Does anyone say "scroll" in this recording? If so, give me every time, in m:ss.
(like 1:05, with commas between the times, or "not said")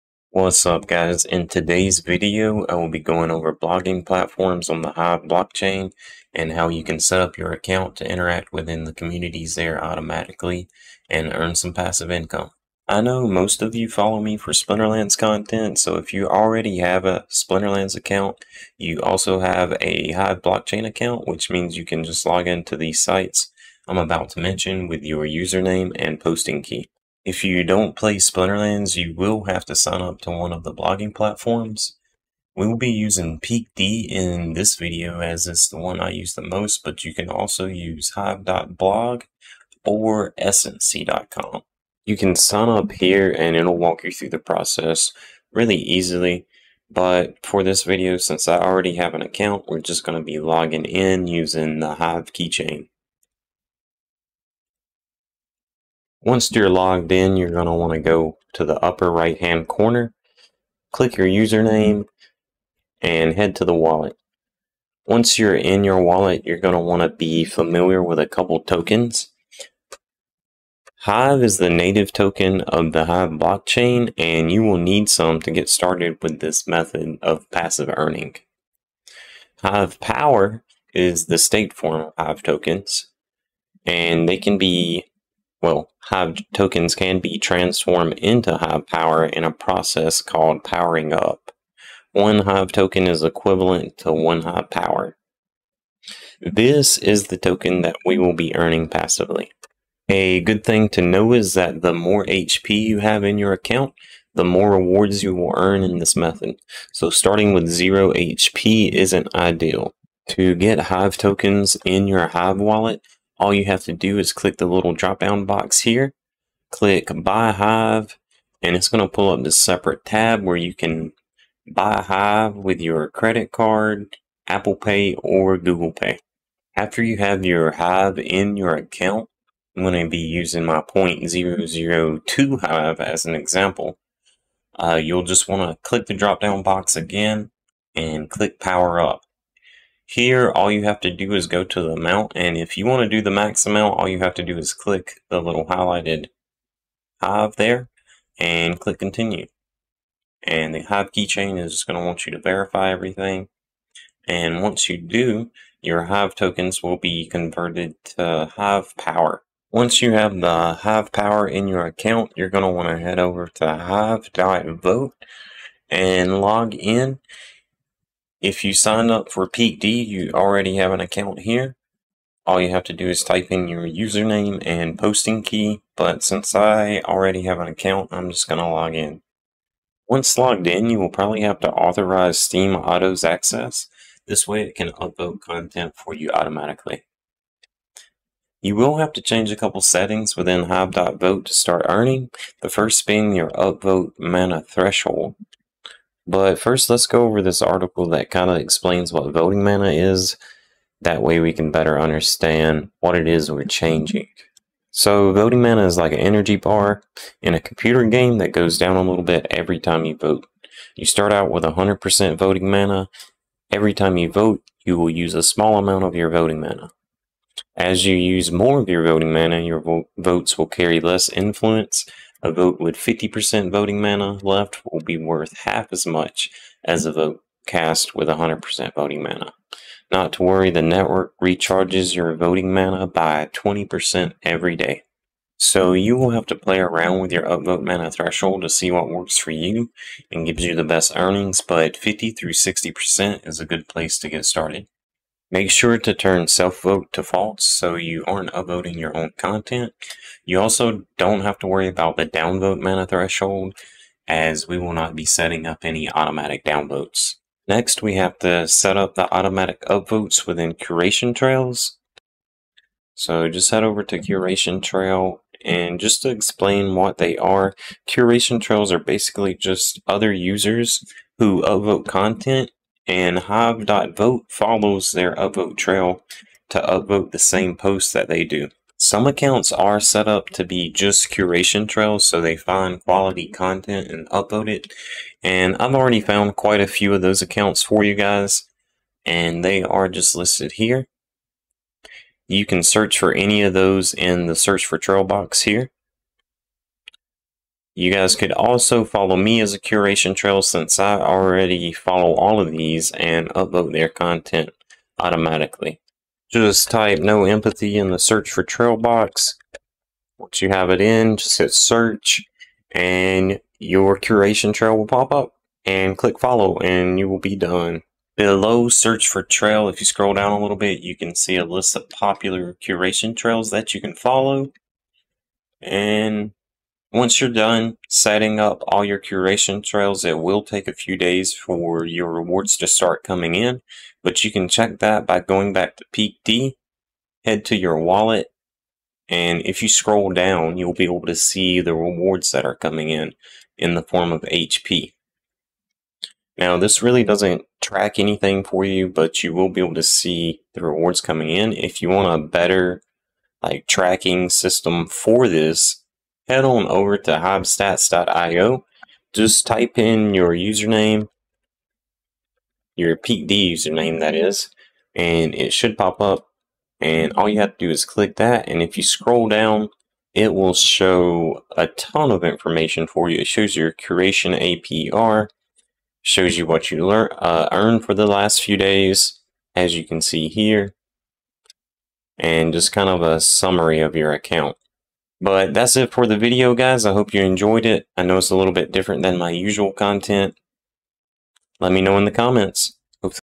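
5:20, 5:39, 6:09.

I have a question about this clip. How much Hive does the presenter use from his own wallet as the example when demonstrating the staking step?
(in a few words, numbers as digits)
0.002 Hive.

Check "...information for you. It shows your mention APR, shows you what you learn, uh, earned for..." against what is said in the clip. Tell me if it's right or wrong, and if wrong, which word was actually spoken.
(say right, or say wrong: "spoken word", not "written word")
wrong: "curation", not "mention".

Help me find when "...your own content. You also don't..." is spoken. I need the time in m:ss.
4:08.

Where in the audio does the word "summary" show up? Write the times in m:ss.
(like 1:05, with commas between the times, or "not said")
6:23.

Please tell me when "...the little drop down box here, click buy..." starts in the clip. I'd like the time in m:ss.
1:54.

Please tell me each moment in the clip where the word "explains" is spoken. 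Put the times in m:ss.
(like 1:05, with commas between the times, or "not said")
3:18, 4:26.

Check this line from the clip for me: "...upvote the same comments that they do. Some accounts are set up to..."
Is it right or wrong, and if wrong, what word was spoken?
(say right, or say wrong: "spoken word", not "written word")
wrong: "posts", not "comments".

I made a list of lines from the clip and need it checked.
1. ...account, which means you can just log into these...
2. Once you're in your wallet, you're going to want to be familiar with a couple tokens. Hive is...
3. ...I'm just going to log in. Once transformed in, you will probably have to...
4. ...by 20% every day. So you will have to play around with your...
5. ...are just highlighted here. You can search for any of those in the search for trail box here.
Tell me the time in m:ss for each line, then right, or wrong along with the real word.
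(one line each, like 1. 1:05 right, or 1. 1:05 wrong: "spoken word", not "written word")
1. 0:20 right
2. 1:05 right
3. 2:58 wrong: "logged", not "transformed"
4. 3:53 right
5. 4:49 wrong: "listed", not "highlighted".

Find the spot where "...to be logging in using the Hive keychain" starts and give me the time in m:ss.
0:50.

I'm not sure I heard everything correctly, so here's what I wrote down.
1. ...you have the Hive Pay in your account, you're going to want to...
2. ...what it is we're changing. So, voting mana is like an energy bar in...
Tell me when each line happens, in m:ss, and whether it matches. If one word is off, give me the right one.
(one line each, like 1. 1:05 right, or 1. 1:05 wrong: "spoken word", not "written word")
1. 2:40 wrong: "Power", not "Pay"
2. 3:23 right.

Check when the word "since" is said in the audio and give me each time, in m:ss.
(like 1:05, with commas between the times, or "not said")
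0:48, 2:56, 5:00.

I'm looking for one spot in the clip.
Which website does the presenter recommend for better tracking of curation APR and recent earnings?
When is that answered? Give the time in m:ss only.
5:57.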